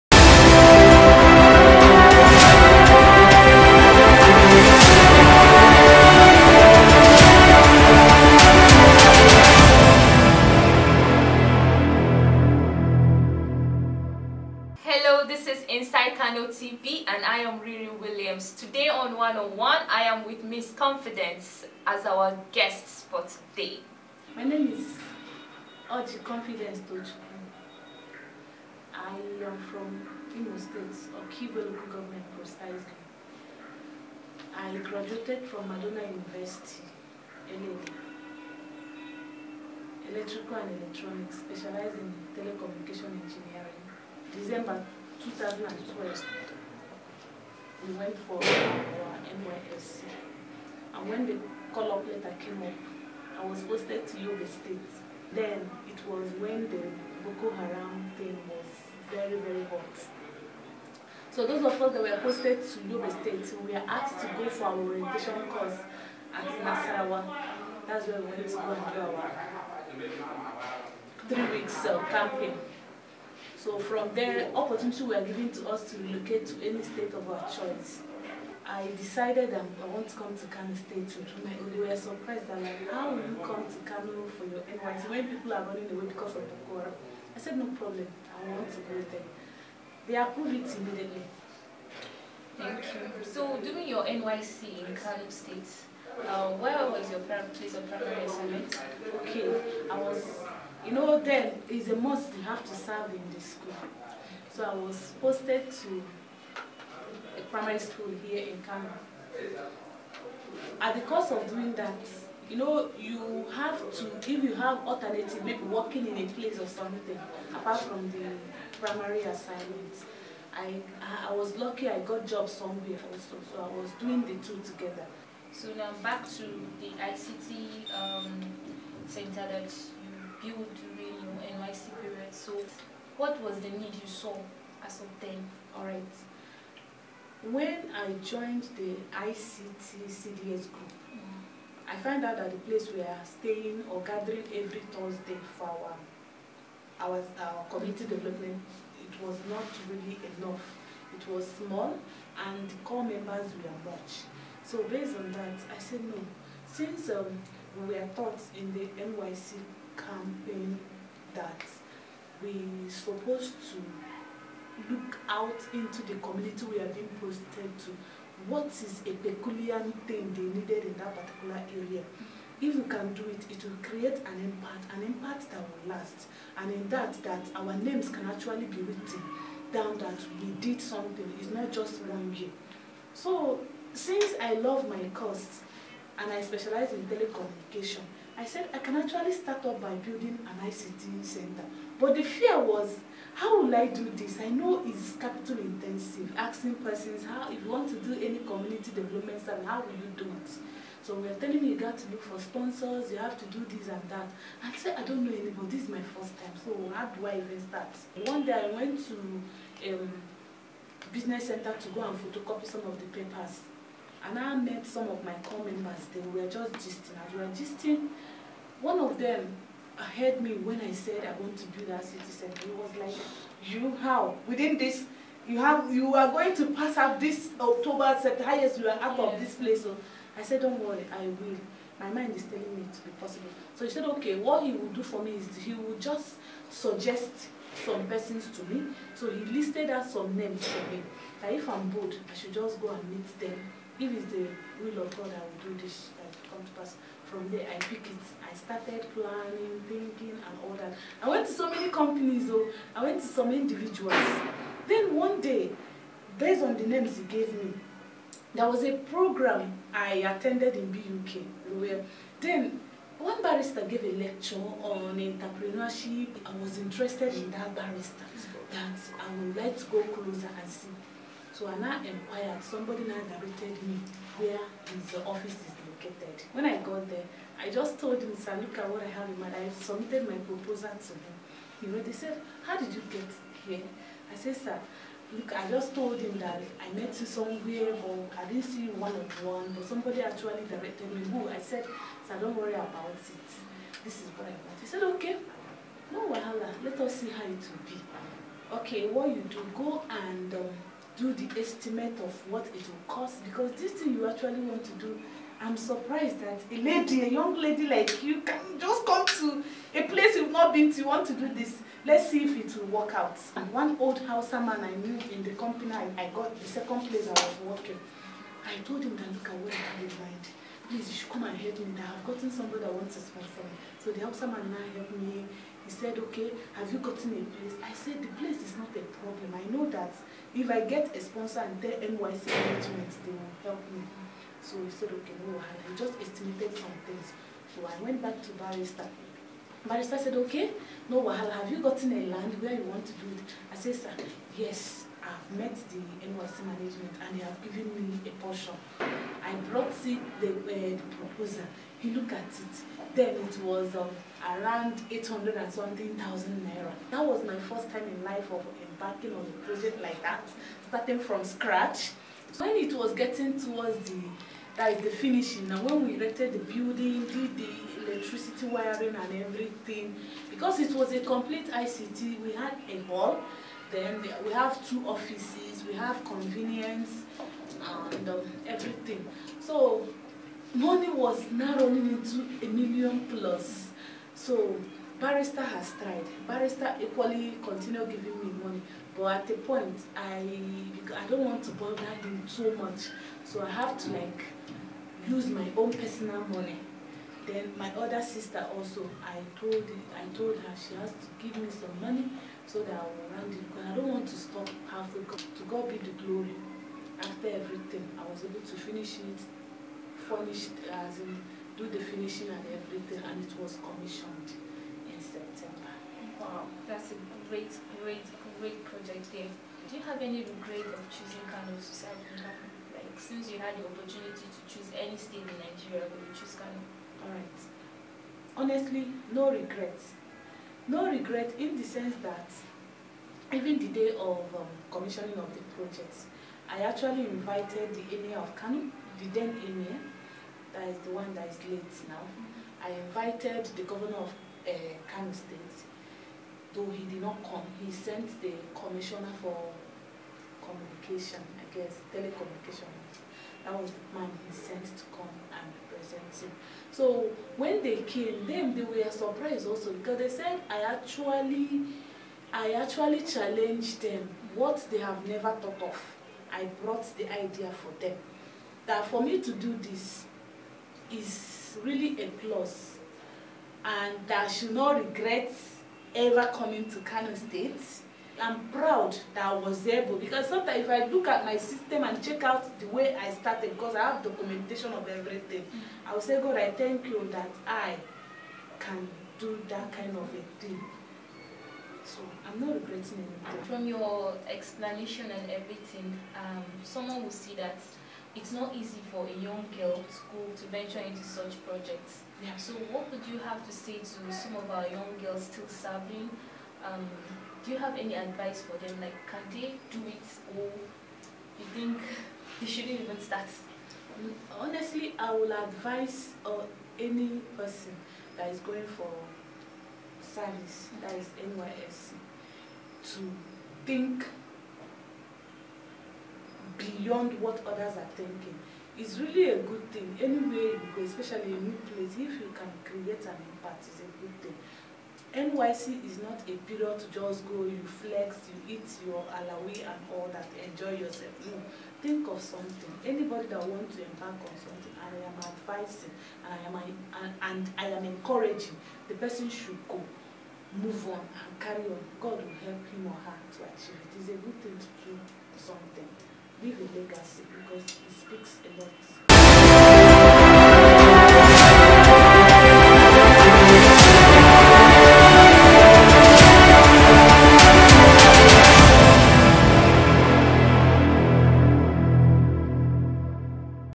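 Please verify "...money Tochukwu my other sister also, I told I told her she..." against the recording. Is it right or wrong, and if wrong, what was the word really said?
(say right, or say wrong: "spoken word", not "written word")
wrong: "Then", not "Tochukwu".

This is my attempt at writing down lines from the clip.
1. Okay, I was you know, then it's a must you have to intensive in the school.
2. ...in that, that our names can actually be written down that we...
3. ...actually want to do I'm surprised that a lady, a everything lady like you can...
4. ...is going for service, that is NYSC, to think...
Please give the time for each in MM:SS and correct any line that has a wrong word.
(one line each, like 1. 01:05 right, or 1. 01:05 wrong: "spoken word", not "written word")
1. 01:39 wrong: "serve", not "intensive"
2. 02:56 right
3. 05:04 wrong: "young", not "everything"
4. 08:38 right.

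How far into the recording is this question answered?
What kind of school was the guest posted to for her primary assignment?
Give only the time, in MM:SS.
01:47.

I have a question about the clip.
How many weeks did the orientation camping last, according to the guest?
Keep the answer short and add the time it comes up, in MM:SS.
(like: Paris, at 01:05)
3, at 01:11.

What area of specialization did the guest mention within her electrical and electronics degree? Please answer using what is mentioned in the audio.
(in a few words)
Telecommunication Engineering.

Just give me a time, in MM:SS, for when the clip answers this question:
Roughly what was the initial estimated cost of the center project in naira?
05:55.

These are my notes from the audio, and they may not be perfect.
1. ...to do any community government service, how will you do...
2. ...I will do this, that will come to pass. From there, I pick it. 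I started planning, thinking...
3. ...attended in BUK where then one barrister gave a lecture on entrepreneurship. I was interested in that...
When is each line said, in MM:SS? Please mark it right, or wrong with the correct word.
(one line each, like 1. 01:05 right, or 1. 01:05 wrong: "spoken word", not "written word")
1. 03:17 wrong: "development", not "government"
2. 04:05 right
3. 04:20 right.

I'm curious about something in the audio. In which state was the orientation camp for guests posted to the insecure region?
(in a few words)
Nasarawa.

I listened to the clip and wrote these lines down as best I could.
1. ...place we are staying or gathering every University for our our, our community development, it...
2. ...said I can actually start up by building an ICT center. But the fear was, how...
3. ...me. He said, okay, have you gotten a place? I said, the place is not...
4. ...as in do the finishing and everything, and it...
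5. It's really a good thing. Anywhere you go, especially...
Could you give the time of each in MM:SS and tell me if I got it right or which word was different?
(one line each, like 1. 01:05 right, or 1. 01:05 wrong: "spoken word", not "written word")
1. 02:22 wrong: "Thursday", not "University"
2. 03:08 right
3. 05:25 right
4. 06:50 right
5. 08:48 right.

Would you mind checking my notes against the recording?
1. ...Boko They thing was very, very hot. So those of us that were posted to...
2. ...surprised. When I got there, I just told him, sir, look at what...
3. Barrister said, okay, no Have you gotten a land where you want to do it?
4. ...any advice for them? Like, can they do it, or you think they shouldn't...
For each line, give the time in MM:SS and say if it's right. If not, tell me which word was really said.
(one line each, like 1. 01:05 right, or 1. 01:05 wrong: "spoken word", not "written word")
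1. 00:57 wrong: "Haram", not "They"
2. 04:35 wrong: "located", not "surprised"
3. 05:39 right
4. 08:27 right.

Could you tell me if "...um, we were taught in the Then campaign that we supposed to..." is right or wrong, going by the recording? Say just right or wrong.
wrong.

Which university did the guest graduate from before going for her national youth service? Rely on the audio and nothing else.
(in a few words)
Madonna University.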